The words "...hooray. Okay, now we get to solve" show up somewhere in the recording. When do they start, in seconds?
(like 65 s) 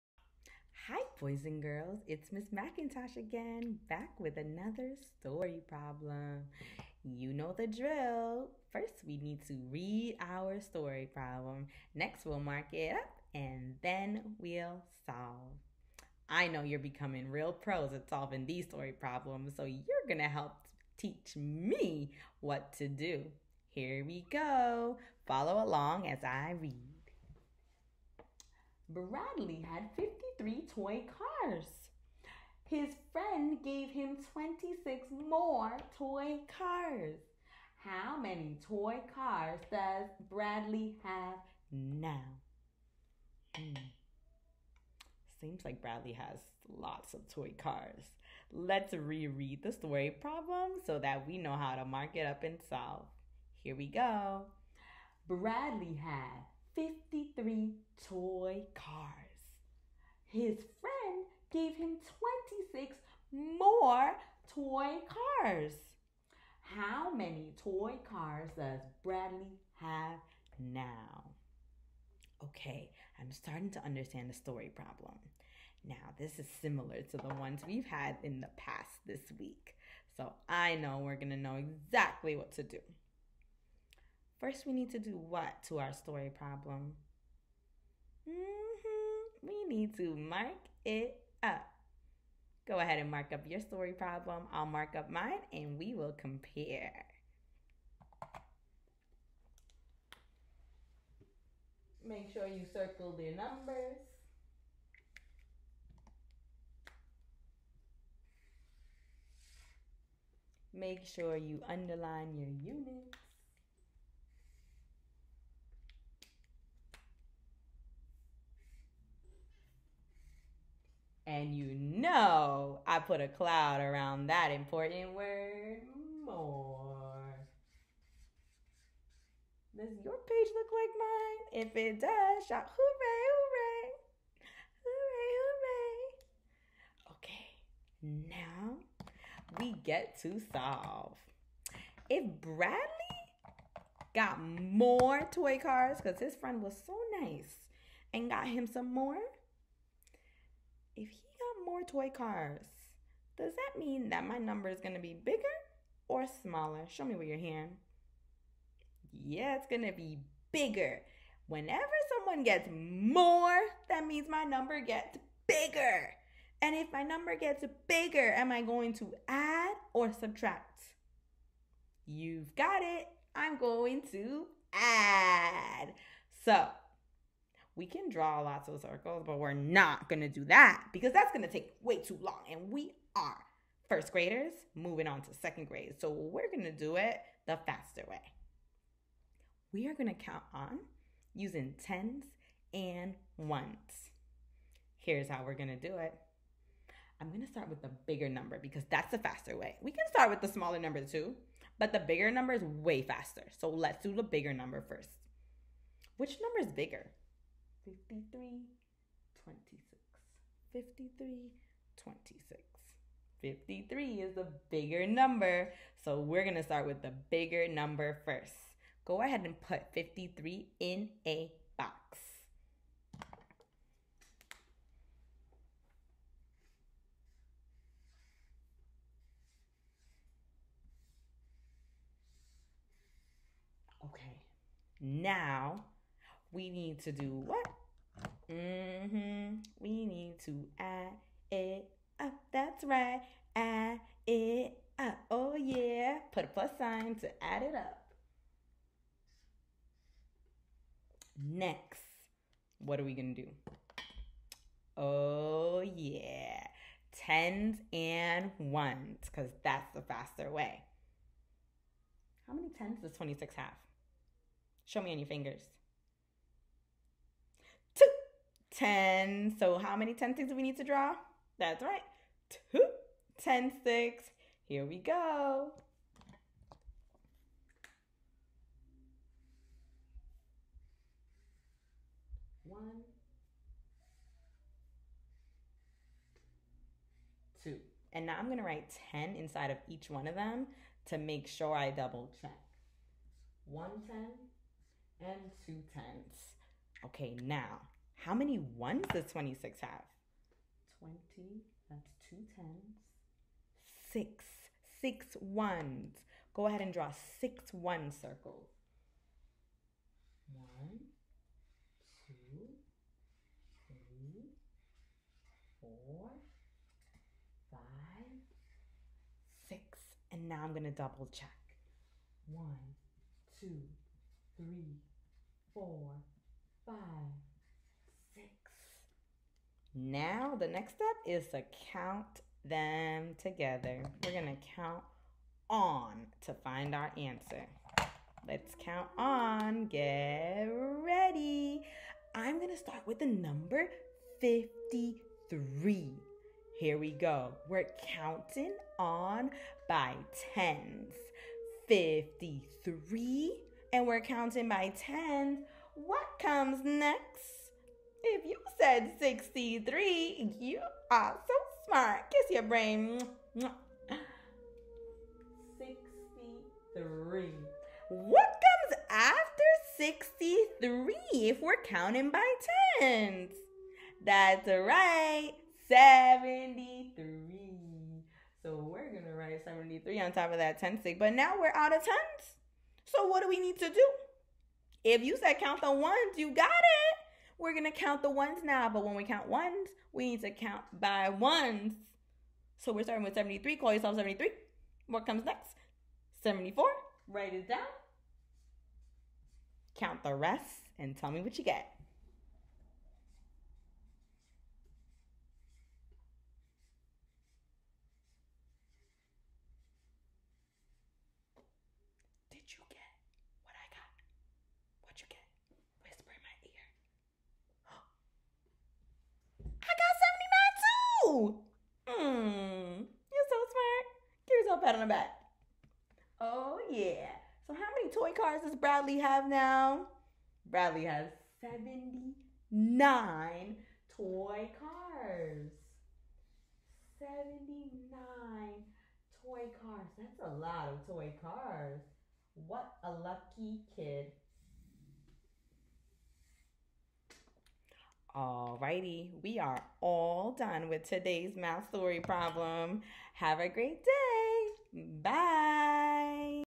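138 s.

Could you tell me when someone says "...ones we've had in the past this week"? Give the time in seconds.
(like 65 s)
77 s.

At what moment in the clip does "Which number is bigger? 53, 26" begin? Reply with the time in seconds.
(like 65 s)
206 s.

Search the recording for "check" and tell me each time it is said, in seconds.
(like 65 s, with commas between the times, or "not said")
292 s, 321 s.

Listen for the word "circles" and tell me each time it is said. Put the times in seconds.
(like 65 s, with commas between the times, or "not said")
102 s, 178 s, 308 s.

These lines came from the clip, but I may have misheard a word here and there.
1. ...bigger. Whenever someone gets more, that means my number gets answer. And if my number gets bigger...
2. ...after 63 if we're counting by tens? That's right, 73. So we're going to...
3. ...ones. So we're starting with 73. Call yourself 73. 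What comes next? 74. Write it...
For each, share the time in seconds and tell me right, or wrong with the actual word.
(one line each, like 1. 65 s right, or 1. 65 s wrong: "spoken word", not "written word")
1. 160 s wrong: "bigger", not "answer"
2. 369 s right
3. 391 s right.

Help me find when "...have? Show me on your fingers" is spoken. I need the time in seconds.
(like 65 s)
263 s.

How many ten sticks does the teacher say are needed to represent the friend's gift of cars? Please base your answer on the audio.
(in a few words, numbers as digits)
2.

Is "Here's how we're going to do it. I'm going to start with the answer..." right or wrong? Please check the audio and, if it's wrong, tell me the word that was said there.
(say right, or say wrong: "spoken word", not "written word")
wrong: "bigger", not "answer".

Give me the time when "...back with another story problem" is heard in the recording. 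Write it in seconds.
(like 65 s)
3 s.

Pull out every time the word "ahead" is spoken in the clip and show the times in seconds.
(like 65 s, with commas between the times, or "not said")
92 s, 219 s, 306 s.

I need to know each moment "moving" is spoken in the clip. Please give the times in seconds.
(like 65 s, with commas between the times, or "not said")
184 s.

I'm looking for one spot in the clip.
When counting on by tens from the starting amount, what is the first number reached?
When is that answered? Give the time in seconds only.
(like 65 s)
358 s.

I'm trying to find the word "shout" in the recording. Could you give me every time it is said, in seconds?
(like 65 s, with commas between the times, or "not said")
132 s.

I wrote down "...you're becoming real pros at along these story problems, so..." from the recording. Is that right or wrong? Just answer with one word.
wrong.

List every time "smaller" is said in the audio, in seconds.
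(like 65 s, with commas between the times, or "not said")
156 s, 200 s.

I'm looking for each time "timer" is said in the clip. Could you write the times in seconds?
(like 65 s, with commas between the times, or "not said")
not said.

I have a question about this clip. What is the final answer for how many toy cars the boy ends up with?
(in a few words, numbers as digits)
79.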